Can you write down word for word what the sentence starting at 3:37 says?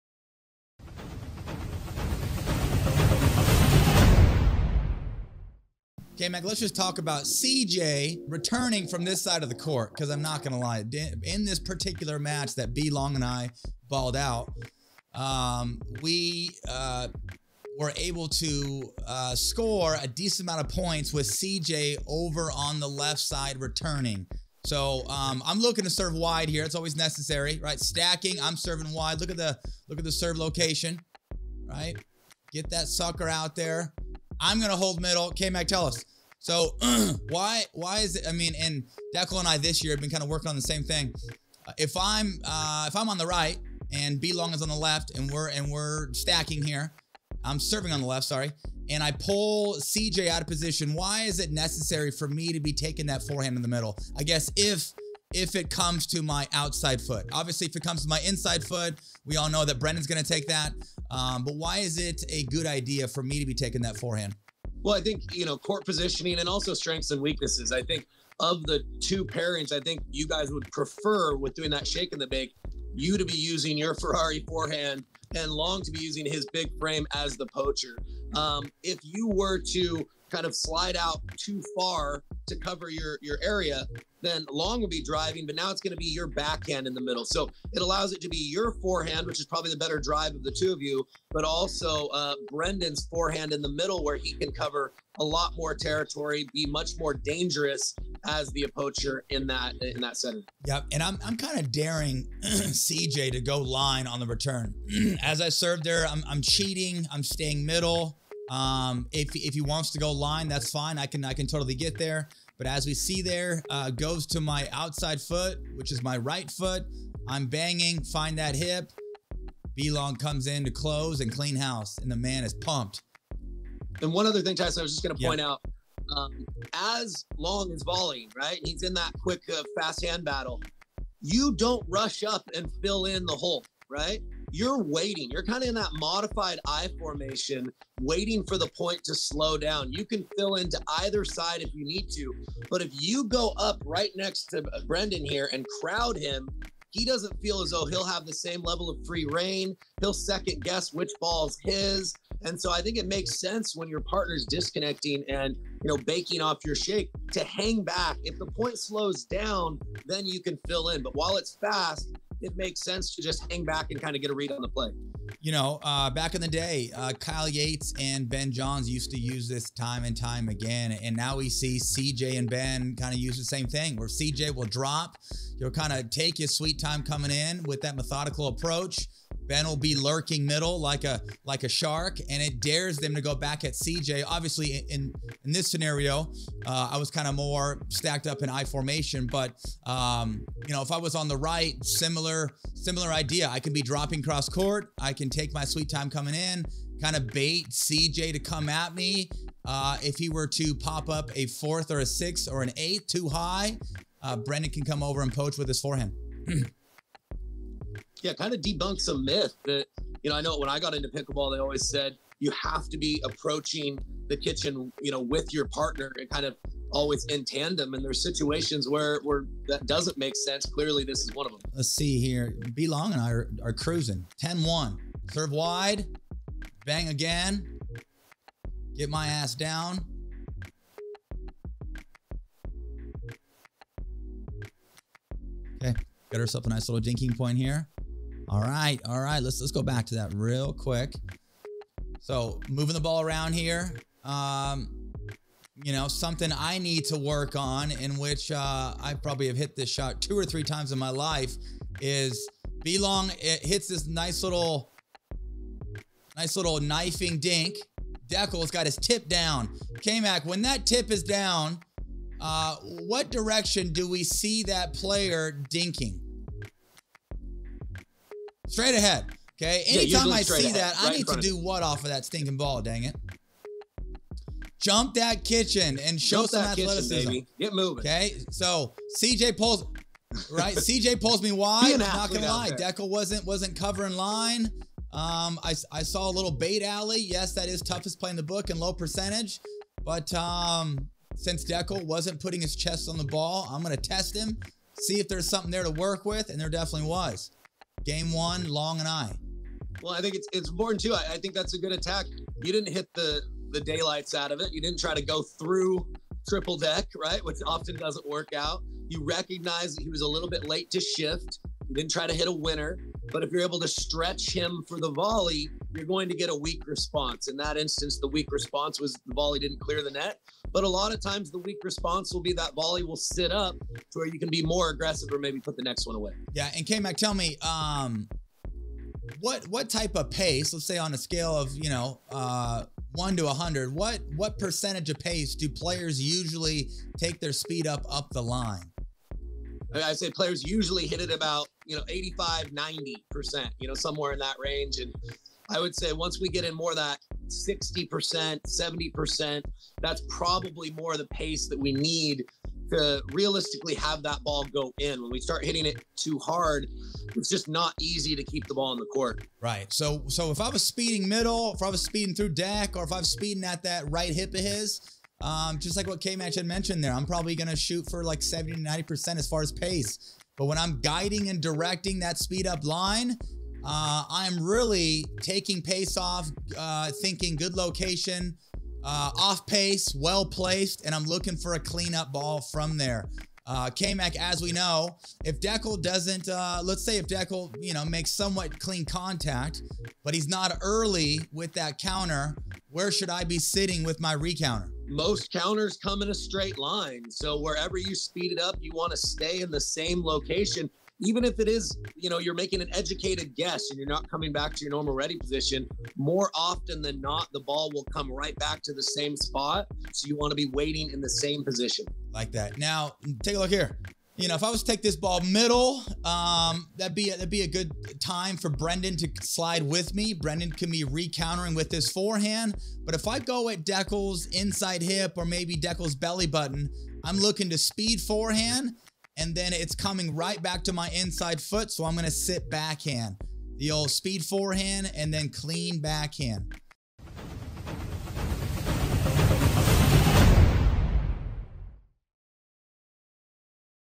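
And there's situations where, where that doesn't make sense.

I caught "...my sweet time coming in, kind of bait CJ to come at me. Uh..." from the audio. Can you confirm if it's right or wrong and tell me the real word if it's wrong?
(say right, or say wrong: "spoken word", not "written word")
right.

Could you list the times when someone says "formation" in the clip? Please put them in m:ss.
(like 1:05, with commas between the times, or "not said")
2:16, 3:08.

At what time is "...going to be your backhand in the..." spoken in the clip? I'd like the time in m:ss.
1:25.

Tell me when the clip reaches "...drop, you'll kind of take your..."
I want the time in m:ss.
2:54.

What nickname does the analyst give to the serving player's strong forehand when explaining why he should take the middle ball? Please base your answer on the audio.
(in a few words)
Ferrari forehand.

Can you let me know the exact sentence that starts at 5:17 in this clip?
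In that instance, the weak response was the volley didn't clear the net.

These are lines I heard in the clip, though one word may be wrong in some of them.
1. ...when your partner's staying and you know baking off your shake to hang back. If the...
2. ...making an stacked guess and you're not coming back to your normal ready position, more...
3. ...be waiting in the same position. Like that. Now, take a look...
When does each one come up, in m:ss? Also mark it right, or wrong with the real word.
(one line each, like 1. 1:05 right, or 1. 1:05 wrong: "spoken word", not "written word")
1. 2:33 wrong: "disconnecting", not "staying"
2. 6:42 wrong: "educated", not "stacked"
3. 6:50 right.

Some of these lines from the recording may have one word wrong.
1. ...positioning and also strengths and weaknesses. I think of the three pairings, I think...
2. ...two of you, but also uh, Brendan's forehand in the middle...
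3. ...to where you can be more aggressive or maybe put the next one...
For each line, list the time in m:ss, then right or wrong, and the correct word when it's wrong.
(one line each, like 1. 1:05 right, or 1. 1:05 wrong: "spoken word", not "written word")
1. 1:05 wrong: "two", not "three"
2. 1:30 right
3. 5:23 right.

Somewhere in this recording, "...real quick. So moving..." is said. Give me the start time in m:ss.
4:00.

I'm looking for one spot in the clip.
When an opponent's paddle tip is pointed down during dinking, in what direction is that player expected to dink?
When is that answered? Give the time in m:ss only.
4:28.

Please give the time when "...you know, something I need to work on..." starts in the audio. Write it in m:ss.
4:05.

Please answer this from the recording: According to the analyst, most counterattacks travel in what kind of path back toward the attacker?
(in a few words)
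a straight line.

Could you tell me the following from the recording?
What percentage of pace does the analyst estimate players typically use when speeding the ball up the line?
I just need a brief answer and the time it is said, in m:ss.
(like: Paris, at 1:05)
85-90%, at 5:42.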